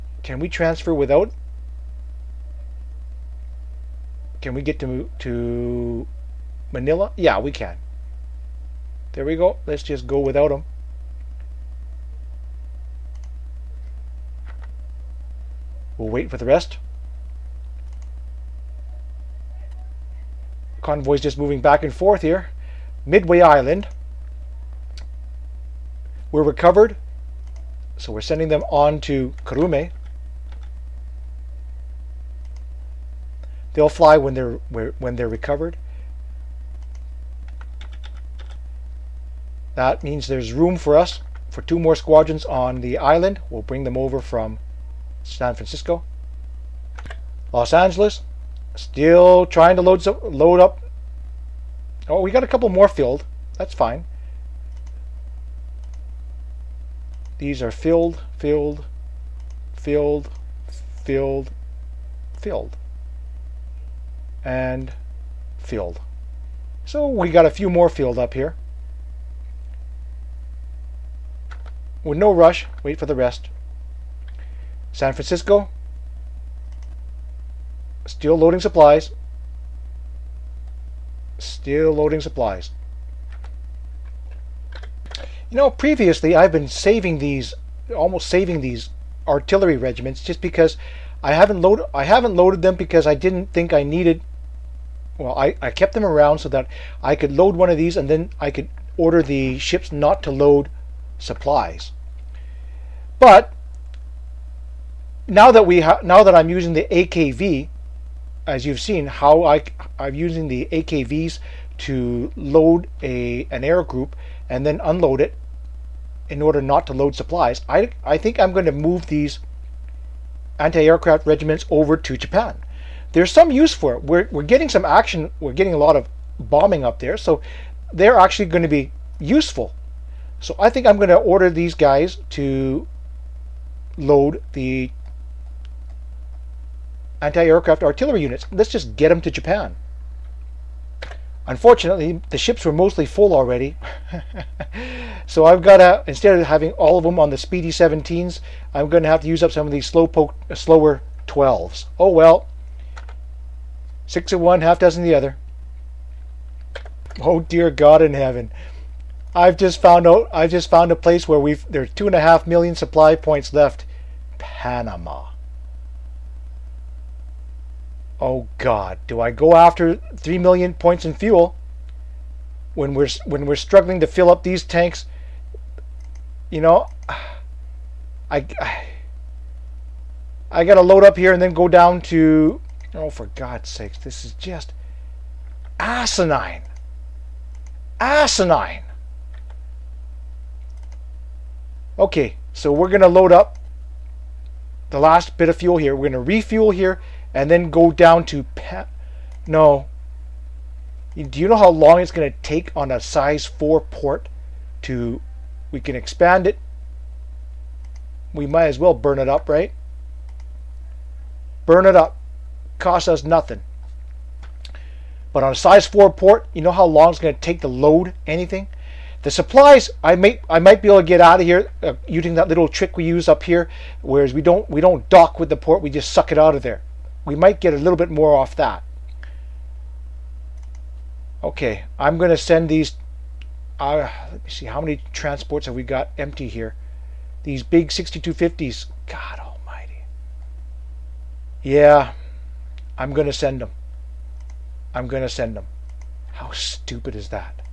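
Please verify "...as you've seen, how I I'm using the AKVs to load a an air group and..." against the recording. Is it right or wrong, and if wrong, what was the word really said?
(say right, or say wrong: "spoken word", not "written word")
right.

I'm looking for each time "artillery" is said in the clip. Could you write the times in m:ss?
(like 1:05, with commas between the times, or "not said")
1:29, 2:17.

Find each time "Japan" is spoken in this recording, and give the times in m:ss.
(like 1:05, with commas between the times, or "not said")
2:02, 2:19.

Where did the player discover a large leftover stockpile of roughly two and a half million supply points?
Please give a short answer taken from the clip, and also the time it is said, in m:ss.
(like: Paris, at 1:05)
Panama, at 2:44.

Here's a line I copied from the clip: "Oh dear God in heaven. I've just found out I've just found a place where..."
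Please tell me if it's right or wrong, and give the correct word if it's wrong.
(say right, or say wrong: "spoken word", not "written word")
right.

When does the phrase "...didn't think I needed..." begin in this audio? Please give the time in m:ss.
1:33.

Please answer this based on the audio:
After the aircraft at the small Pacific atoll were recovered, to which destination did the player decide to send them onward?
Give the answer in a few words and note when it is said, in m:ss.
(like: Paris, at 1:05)
Kurume, at 0:29.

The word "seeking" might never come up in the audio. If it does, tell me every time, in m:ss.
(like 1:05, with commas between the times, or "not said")
not said.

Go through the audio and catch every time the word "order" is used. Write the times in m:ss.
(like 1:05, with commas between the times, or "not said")
1:38, 1:56, 2:11.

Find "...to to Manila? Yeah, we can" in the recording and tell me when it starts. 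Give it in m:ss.
0:04.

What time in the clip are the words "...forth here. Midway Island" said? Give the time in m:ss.
0:21.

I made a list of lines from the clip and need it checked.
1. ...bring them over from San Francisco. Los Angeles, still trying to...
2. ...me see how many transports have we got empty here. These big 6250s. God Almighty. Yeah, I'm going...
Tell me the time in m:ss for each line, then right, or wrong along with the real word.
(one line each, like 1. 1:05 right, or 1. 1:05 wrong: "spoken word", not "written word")
1. 0:43 right
2. 3:54 right.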